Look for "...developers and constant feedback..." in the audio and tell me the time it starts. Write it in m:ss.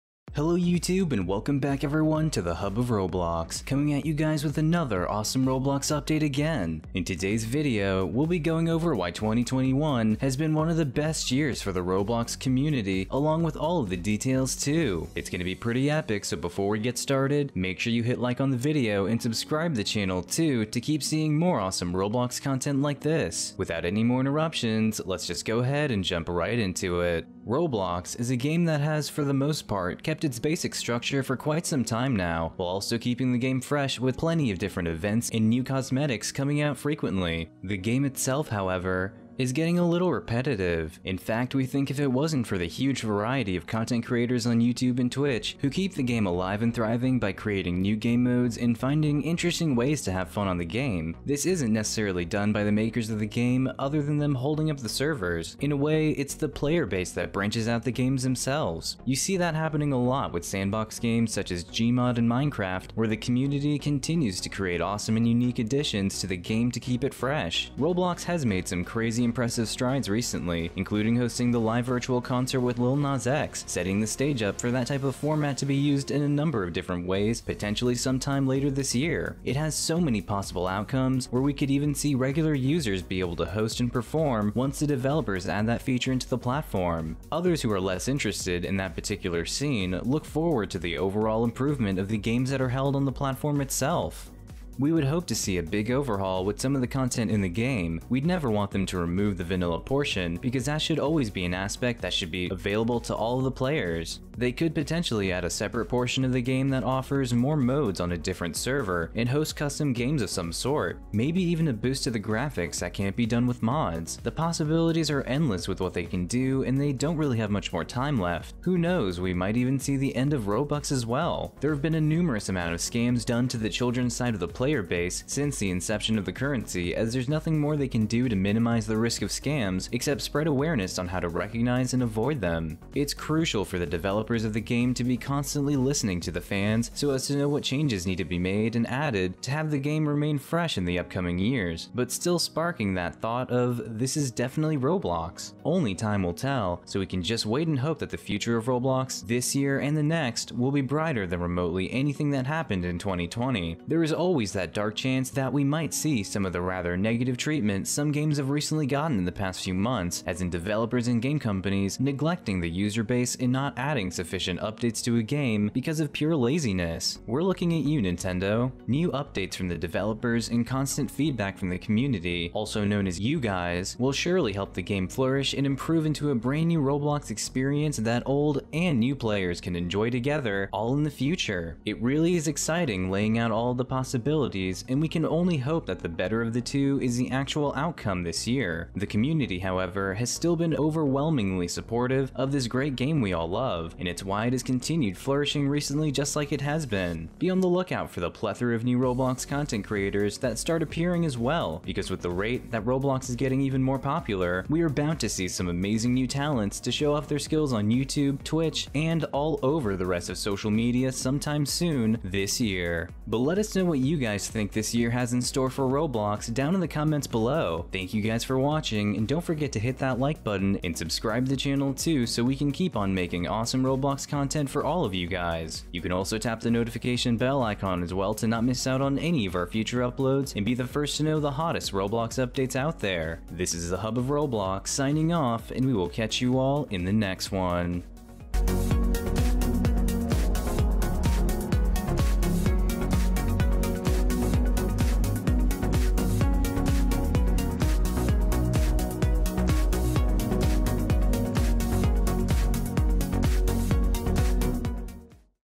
2:49.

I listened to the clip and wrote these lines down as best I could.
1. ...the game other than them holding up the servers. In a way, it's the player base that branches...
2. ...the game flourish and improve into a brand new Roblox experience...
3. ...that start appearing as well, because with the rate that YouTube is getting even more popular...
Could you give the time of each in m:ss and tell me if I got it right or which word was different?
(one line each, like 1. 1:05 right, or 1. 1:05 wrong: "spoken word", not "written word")
1. 0:53 right
2. 2:54 right
3. 3:20 wrong: "Roblox", not "YouTube".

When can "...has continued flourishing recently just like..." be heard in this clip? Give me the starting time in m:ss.
3:14.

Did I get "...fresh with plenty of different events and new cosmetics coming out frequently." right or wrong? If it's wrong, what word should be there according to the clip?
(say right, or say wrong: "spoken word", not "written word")
right.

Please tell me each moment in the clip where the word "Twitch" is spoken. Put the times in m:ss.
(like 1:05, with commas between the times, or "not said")
0:45, 3:28.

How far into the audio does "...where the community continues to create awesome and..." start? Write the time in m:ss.
1:02.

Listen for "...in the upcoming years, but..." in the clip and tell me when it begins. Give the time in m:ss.
2:20.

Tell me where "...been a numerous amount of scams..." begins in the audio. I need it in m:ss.
2:01.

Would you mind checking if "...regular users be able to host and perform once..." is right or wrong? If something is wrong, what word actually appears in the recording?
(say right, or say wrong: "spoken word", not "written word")
right.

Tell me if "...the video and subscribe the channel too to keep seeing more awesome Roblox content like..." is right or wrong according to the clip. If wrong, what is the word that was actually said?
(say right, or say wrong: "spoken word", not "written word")
right.